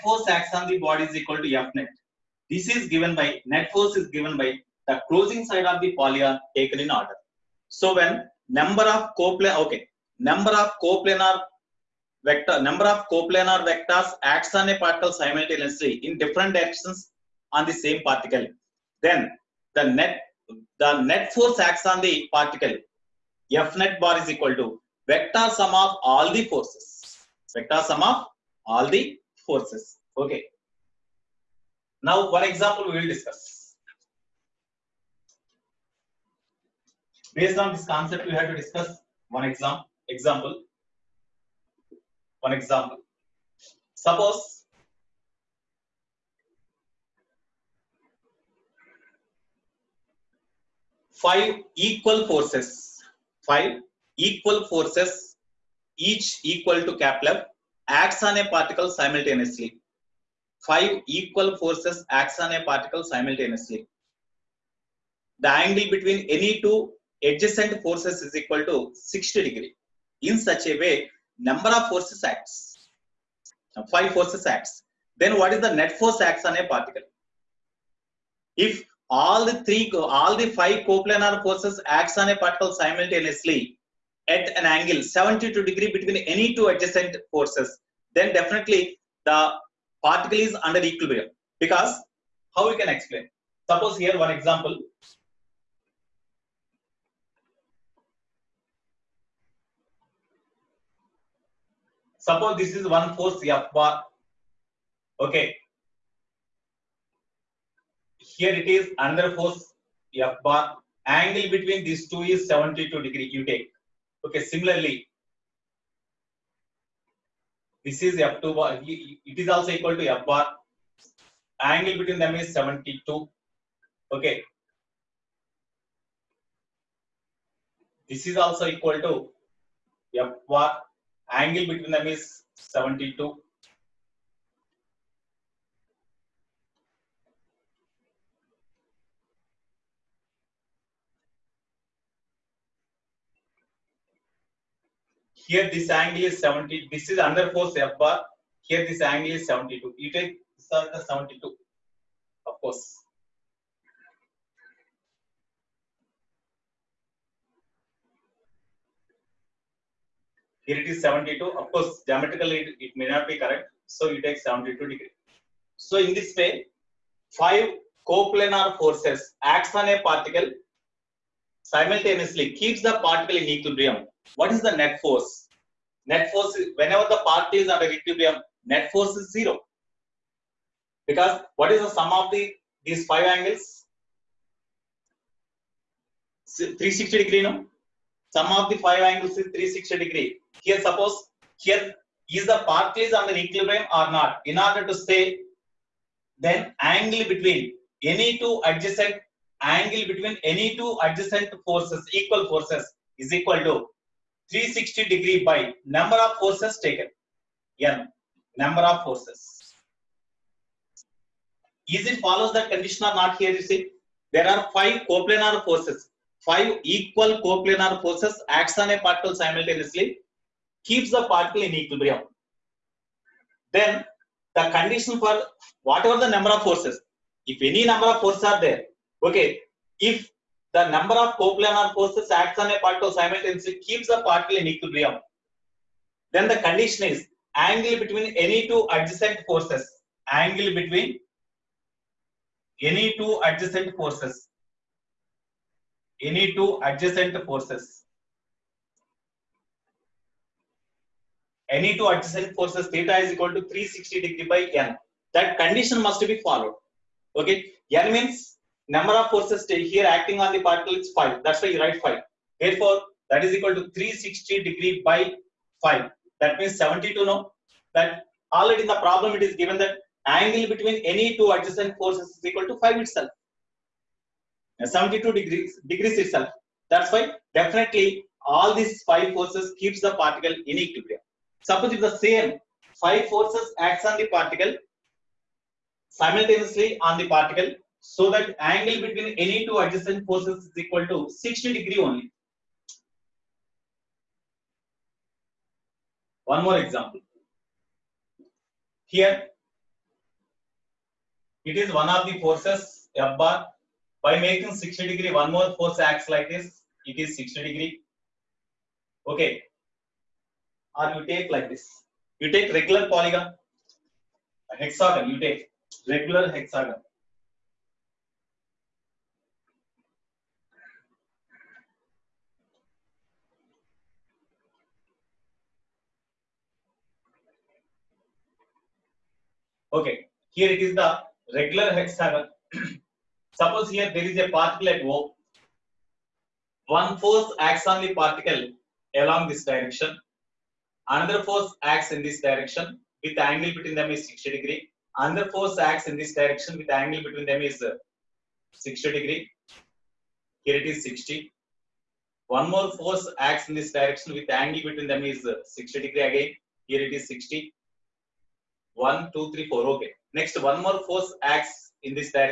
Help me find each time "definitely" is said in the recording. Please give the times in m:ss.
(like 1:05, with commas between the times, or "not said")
1:28, 4:37.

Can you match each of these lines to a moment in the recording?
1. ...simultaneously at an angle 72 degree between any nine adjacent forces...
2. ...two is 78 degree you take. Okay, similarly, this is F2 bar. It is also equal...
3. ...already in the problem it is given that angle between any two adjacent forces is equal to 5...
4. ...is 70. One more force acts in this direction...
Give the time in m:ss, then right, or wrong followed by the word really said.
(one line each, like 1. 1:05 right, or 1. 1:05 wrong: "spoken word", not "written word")
1. 1:22 wrong: "two", not "nine"
2. 1:52 wrong: "72", not "78"
3. 4:28 right
4. 5:50 wrong: "60", not "70".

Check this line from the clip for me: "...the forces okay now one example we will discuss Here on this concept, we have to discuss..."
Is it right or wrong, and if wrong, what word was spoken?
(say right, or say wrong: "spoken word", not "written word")
wrong: "Based", not "Here".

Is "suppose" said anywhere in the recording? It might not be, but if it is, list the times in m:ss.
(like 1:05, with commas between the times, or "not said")
0:43, 1:33, 1:42, 3:10, 4:41, 5:33.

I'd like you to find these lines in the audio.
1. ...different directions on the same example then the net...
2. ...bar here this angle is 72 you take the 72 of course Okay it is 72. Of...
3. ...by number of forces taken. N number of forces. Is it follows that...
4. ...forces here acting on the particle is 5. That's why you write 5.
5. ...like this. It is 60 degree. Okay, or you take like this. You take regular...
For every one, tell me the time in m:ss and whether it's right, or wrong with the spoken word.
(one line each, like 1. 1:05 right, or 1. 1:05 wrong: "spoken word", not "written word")
1. 0:16 wrong: "particle", not "example"
2. 2:28 wrong: "Here", not "Okay"
3. 3:25 right
4. 4:19 right
5. 5:06 right.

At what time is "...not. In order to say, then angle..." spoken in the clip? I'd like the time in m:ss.
3:14.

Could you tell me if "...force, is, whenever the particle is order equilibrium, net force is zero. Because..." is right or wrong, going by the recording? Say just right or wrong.
wrong.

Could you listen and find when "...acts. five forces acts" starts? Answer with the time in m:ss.
1:12.